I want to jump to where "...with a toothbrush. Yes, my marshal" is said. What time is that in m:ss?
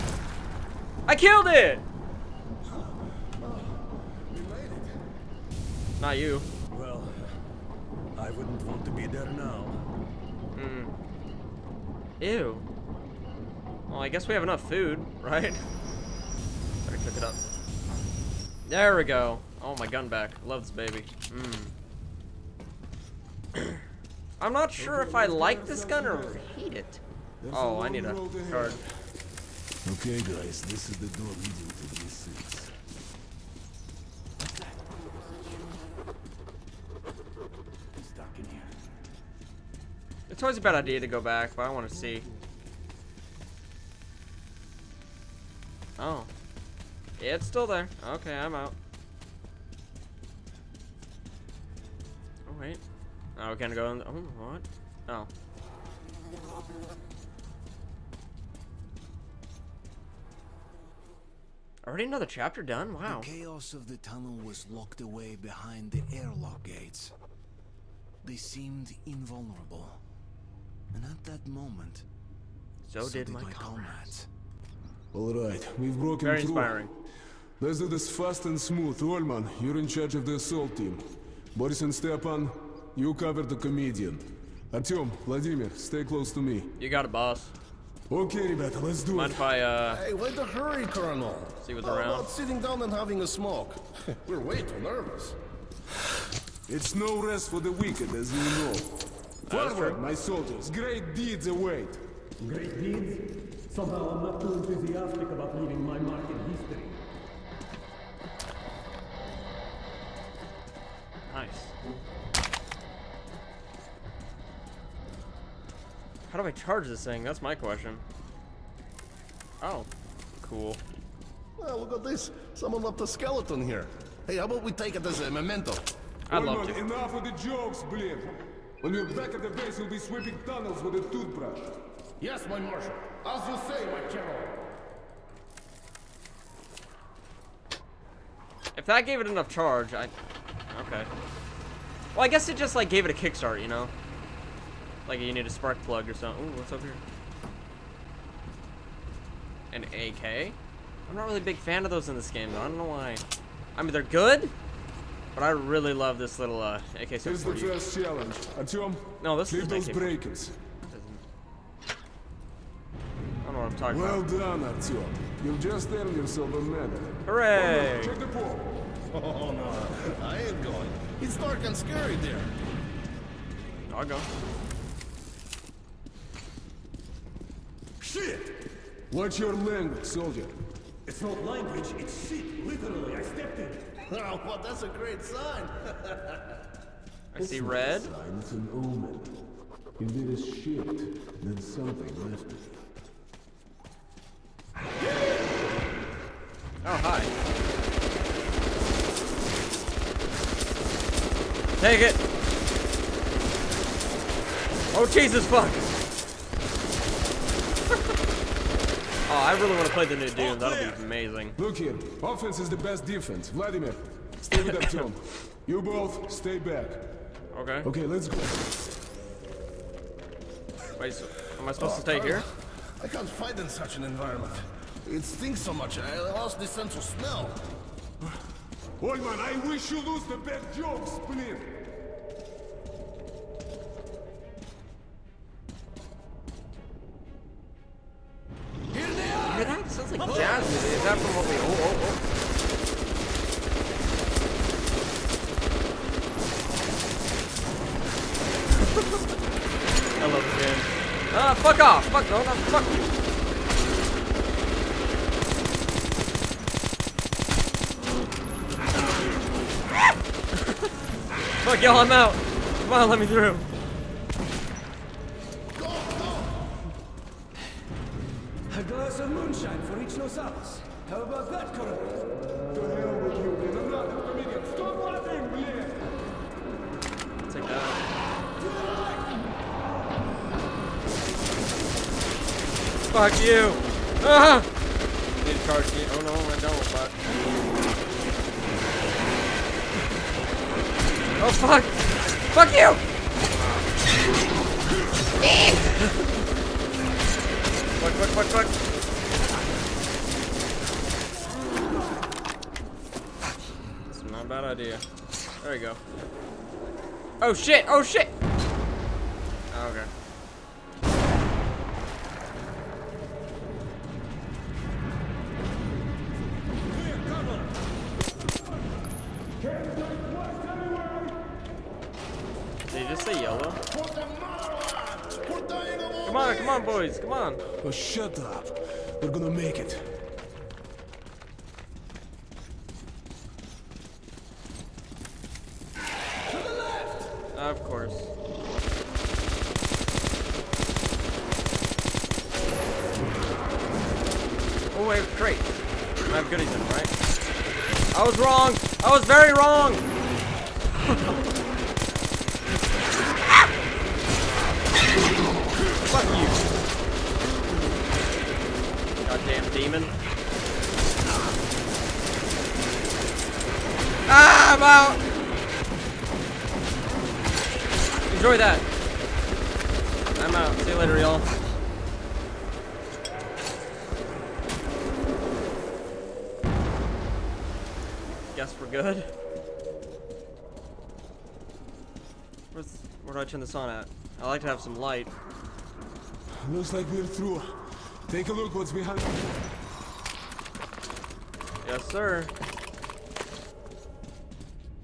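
2:10.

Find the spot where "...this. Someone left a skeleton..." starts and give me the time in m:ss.
2:02.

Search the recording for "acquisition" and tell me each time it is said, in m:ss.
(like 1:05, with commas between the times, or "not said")
not said.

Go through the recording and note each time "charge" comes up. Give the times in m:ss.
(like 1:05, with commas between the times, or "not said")
1:19, 1:56, 2:19, 4:45.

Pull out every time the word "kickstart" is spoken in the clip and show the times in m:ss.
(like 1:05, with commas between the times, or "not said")
2:23.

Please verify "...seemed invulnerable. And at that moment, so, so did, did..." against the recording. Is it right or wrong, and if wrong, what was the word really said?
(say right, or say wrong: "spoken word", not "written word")
right.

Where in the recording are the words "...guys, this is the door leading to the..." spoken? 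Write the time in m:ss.
0:30.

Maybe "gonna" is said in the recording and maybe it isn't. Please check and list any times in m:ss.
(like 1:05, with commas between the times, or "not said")
0:53, 5:29.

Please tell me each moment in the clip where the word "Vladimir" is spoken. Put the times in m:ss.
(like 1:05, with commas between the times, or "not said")
1:25, 3:33.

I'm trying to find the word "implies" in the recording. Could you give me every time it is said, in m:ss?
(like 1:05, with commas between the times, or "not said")
not said.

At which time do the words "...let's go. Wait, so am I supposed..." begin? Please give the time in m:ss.
3:38.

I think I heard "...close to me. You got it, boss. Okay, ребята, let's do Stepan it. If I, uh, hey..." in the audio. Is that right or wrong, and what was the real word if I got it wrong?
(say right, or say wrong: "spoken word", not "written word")
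wrong: "Mind", not "Stepan".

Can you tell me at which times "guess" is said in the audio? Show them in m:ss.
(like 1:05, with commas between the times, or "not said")
0:14, 2:22, 6:18.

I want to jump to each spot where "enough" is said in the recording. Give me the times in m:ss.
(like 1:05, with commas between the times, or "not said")
0:14, 2:06, 2:19.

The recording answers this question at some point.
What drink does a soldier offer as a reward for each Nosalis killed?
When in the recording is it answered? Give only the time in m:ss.
4:28.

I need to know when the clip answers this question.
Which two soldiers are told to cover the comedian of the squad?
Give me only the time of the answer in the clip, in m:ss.
1:21.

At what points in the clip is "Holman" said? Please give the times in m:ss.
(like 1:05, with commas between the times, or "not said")
3:49.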